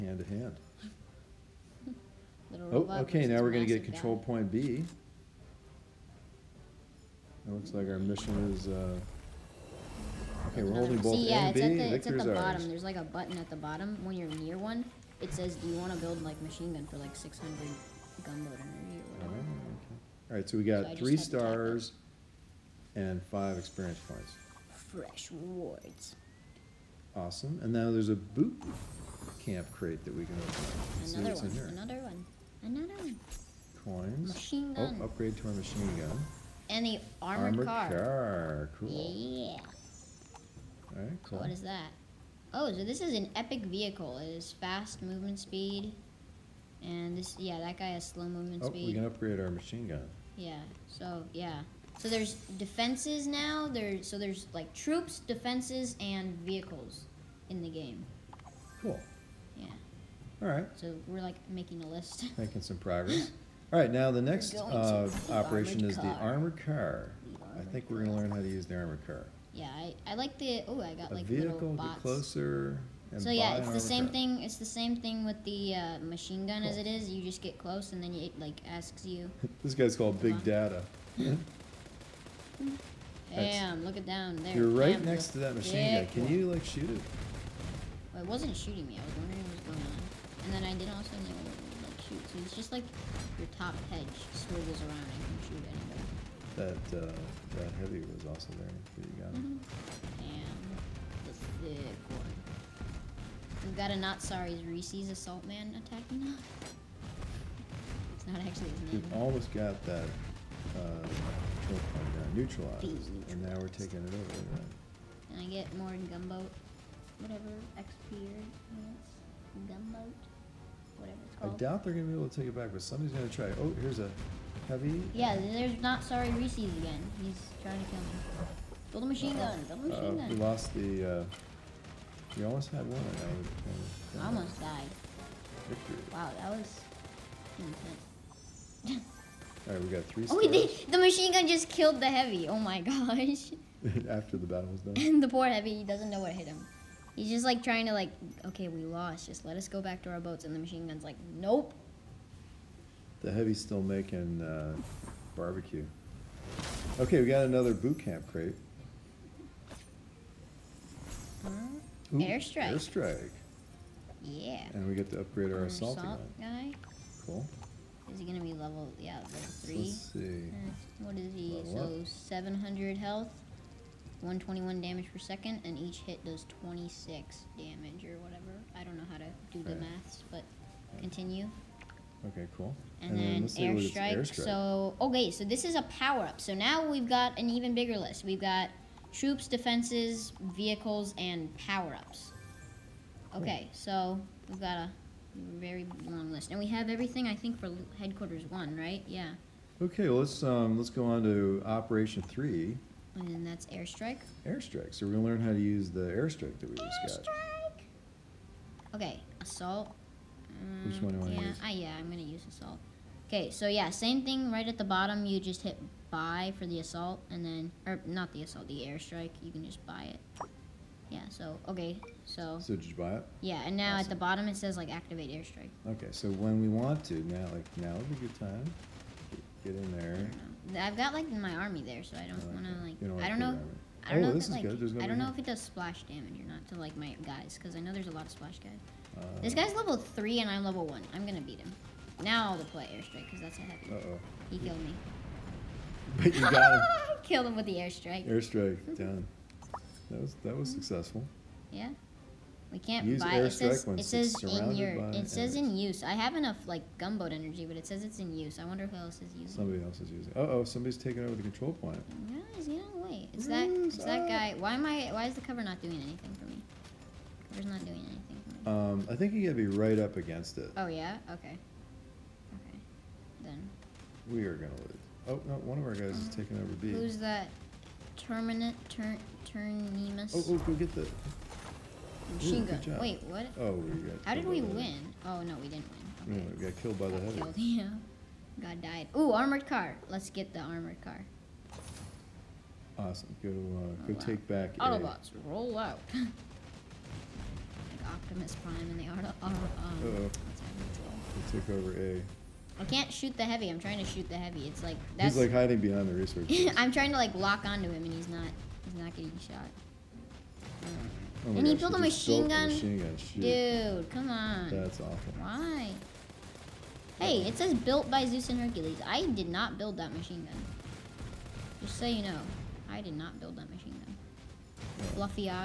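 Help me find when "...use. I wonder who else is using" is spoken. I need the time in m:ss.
4:18.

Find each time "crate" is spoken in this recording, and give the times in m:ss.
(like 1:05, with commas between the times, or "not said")
0:29, 2:38.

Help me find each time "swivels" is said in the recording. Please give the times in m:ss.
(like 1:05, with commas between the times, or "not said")
1:34.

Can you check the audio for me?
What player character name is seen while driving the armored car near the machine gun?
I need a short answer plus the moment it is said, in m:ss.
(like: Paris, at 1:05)
Big Data, at 1:20.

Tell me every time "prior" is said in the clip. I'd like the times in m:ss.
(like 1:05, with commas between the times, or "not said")
not said.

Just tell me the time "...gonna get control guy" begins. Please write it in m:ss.
0:03.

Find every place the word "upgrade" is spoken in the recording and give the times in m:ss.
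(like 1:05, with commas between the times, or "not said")
0:35, 0:49, 2:45.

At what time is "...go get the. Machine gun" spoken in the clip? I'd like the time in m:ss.
4:40.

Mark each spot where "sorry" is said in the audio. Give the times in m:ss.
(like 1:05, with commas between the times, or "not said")
1:44, 2:06.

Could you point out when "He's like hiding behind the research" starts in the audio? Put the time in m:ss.
5:05.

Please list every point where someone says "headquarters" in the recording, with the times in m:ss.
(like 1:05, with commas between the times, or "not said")
3:17.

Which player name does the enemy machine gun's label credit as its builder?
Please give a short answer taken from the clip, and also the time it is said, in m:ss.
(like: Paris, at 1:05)
Zeus and Hercules, at 5:18.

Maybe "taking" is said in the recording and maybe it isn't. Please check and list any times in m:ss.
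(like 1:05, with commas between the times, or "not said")
1:53, 4:20, 4:36.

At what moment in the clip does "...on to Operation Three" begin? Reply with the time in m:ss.
3:21.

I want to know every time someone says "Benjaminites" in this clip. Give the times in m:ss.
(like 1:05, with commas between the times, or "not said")
not said.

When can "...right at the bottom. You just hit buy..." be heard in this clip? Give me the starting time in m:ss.
3:34.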